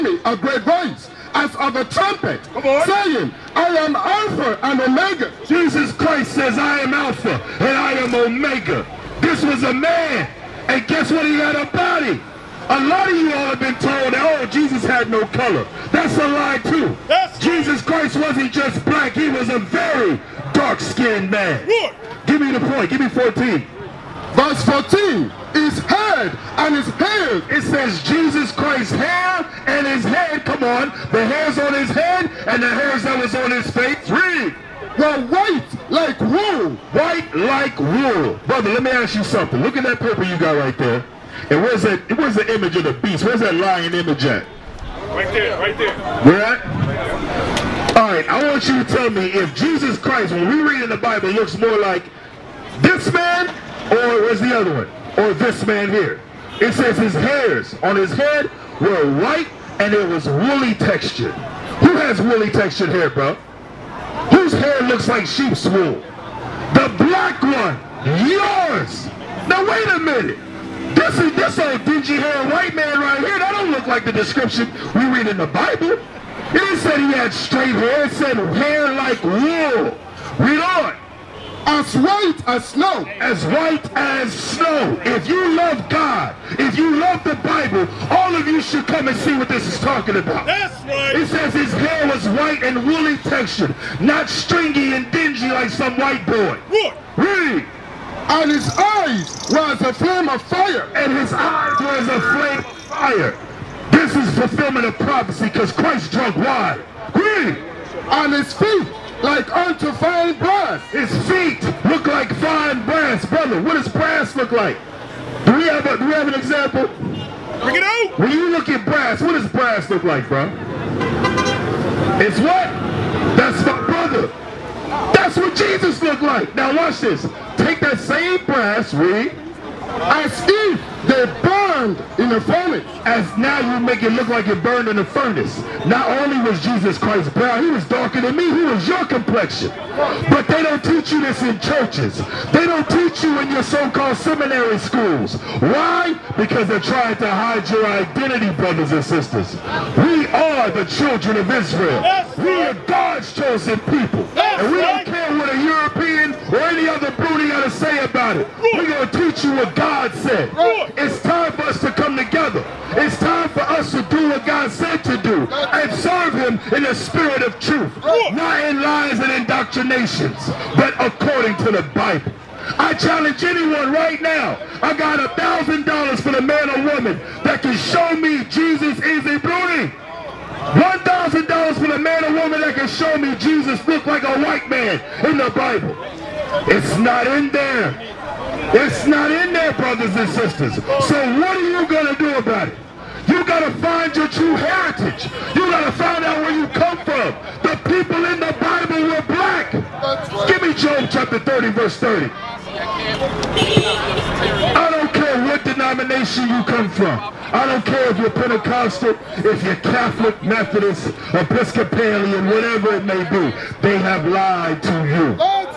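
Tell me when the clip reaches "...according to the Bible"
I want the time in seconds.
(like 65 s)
170 s.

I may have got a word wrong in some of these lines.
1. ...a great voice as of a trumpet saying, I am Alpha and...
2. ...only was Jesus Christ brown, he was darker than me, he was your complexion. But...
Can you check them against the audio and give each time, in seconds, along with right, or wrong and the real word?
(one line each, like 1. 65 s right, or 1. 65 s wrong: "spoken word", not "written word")
1. 0 s right
2. 136 s right.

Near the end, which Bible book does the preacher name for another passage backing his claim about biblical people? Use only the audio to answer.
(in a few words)
Job.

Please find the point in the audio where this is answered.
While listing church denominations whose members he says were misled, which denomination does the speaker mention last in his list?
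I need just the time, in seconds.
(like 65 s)
211 s.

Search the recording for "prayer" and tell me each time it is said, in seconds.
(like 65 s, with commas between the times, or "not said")
not said.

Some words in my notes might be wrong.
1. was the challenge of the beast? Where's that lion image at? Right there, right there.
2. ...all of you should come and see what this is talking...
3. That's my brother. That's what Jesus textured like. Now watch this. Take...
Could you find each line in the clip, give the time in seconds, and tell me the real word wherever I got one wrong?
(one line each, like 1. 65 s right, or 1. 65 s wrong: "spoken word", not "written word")
1. 42 s wrong: "image", not "challenge"
2. 88 s right
3. 123 s wrong: "looked", not "textured".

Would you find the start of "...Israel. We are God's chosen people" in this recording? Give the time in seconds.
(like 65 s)
151 s.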